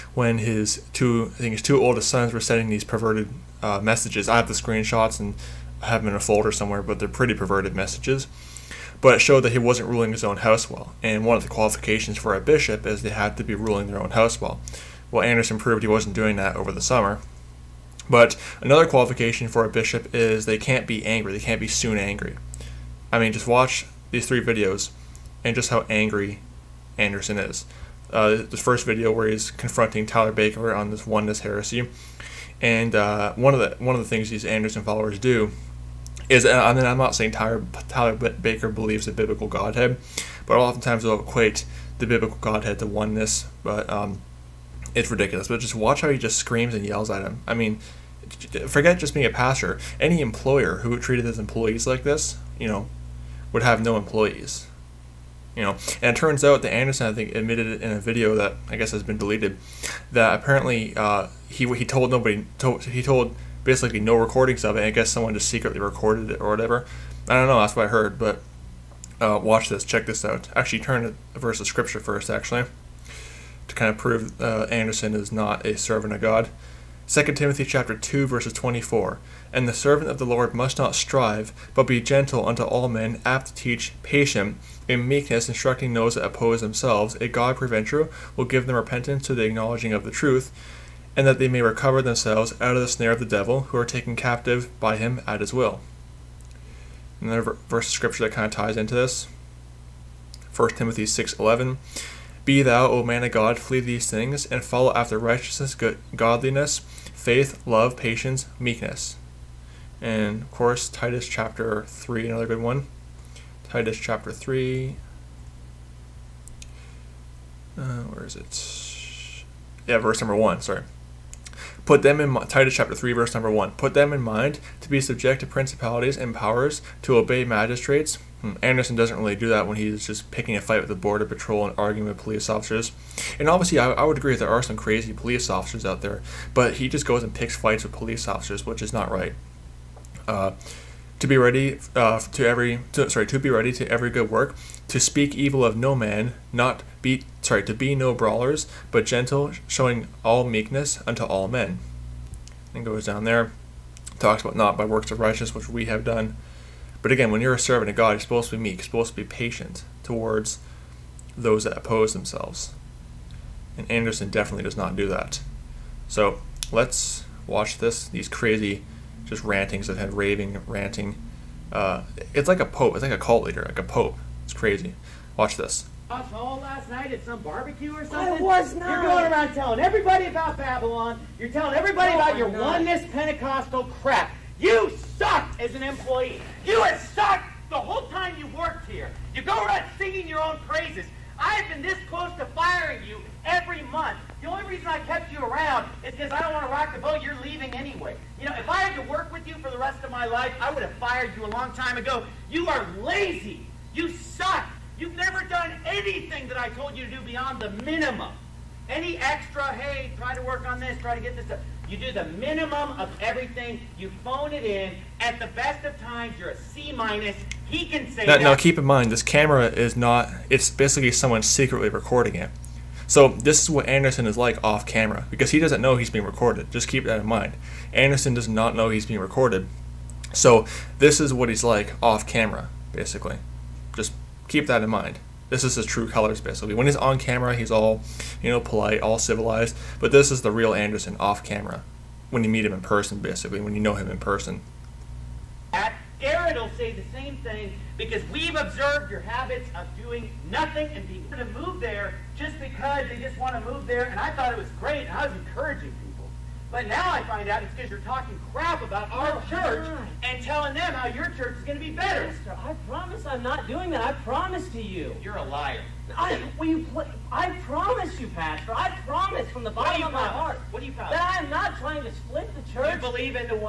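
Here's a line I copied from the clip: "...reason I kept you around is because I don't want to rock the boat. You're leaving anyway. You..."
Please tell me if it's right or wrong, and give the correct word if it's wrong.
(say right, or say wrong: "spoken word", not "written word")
right.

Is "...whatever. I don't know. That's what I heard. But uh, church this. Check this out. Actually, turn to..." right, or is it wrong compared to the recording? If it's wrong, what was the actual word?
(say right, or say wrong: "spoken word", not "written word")
wrong: "watch", not "church".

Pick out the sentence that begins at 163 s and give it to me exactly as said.
And Anderson definitely does not do that.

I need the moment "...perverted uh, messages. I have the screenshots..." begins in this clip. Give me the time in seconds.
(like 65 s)
2 s.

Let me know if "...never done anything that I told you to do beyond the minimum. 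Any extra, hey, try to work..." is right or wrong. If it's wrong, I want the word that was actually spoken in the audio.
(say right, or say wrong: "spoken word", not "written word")
right.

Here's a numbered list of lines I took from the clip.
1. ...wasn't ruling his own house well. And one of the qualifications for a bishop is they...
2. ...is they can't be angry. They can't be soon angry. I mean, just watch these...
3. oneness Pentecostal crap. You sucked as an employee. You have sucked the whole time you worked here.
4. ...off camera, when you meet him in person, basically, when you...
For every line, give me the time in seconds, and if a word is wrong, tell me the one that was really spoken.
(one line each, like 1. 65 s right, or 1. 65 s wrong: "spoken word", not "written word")
1. 9 s right
2. 20 s right
3. 182 s right
4. 241 s right.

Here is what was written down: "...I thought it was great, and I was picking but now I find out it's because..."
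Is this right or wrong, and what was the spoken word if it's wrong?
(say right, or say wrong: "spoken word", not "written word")
wrong: "encouraging", not "picking".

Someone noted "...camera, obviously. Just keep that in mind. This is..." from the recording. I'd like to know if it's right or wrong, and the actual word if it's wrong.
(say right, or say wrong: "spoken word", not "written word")
wrong: "basically", not "obviously".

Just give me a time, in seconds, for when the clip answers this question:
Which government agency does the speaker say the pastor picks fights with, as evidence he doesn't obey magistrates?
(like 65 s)
130 s.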